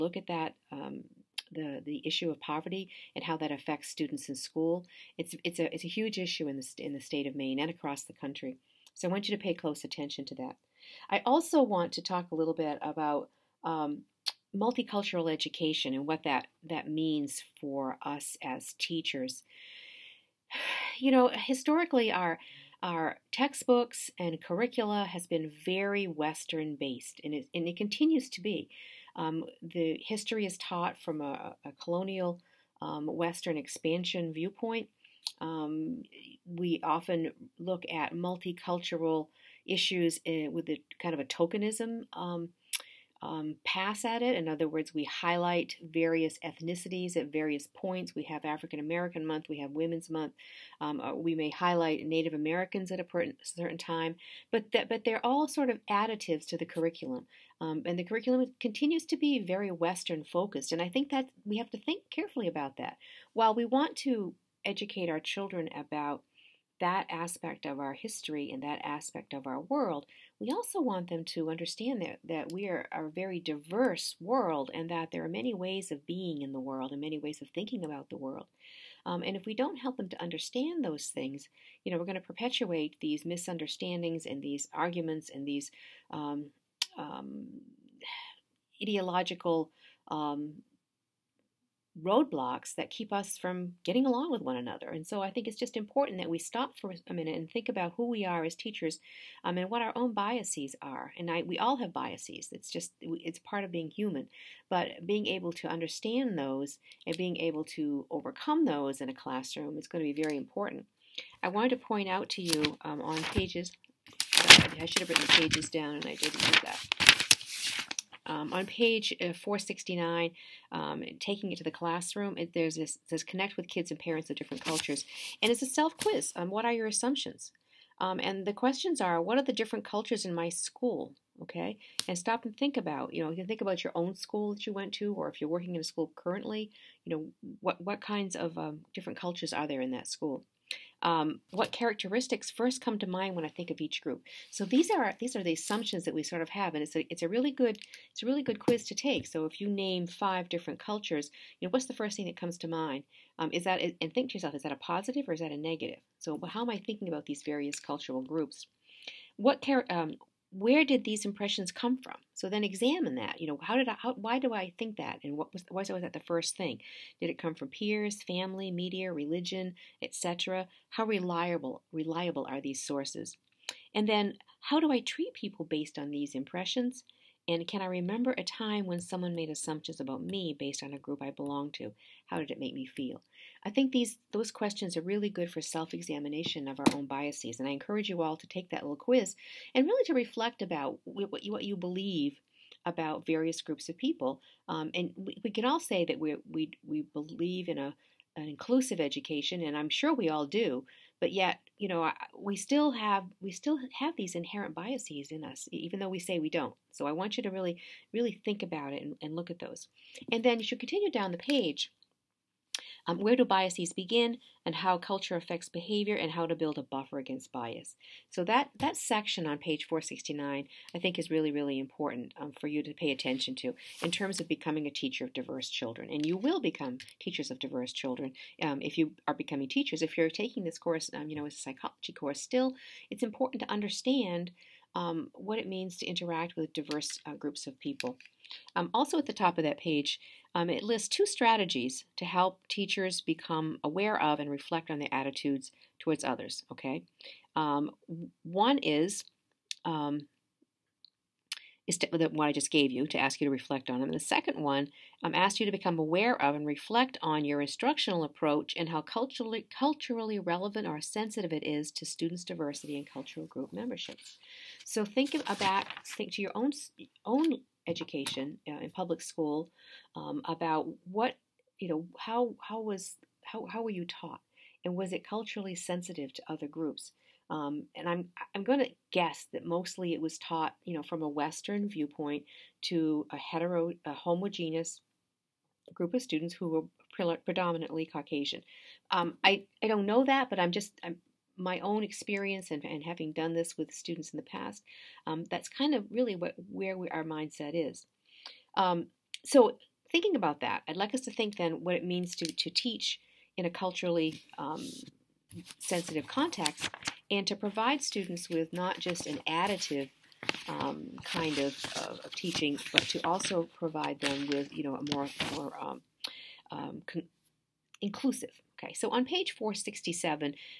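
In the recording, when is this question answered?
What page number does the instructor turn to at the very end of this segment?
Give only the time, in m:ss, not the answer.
5:19.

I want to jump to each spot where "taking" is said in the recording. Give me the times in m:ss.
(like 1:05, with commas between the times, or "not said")
2:01, 3:50.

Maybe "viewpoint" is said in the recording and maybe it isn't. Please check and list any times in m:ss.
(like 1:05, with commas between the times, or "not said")
0:34, 4:41.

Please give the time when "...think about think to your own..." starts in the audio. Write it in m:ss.
4:25.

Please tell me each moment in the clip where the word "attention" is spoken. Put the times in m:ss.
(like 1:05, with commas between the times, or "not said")
0:09, 3:43.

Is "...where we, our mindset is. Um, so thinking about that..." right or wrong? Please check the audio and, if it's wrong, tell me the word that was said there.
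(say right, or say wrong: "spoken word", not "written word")
right.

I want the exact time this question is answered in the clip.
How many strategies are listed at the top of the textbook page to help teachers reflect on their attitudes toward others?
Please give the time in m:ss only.
4:01.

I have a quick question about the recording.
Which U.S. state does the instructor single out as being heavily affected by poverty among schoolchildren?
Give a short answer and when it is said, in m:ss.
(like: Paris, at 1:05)
Maine, at 0:07.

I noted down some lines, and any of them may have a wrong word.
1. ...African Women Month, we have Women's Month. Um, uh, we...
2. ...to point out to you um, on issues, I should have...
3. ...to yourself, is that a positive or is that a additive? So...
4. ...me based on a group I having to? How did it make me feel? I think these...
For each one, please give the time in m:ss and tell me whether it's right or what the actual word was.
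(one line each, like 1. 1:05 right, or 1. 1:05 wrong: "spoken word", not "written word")
1. 0:48 wrong: "American", not "Women"
2. 1:51 wrong: "pages", not "issues"
3. 2:34 wrong: "negative", not "additive"
4. 3:00 wrong: "belong", not "having".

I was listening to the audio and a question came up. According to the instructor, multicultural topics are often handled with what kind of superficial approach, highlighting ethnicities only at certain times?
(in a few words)
tokenism.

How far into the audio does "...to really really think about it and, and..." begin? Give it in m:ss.
3:27.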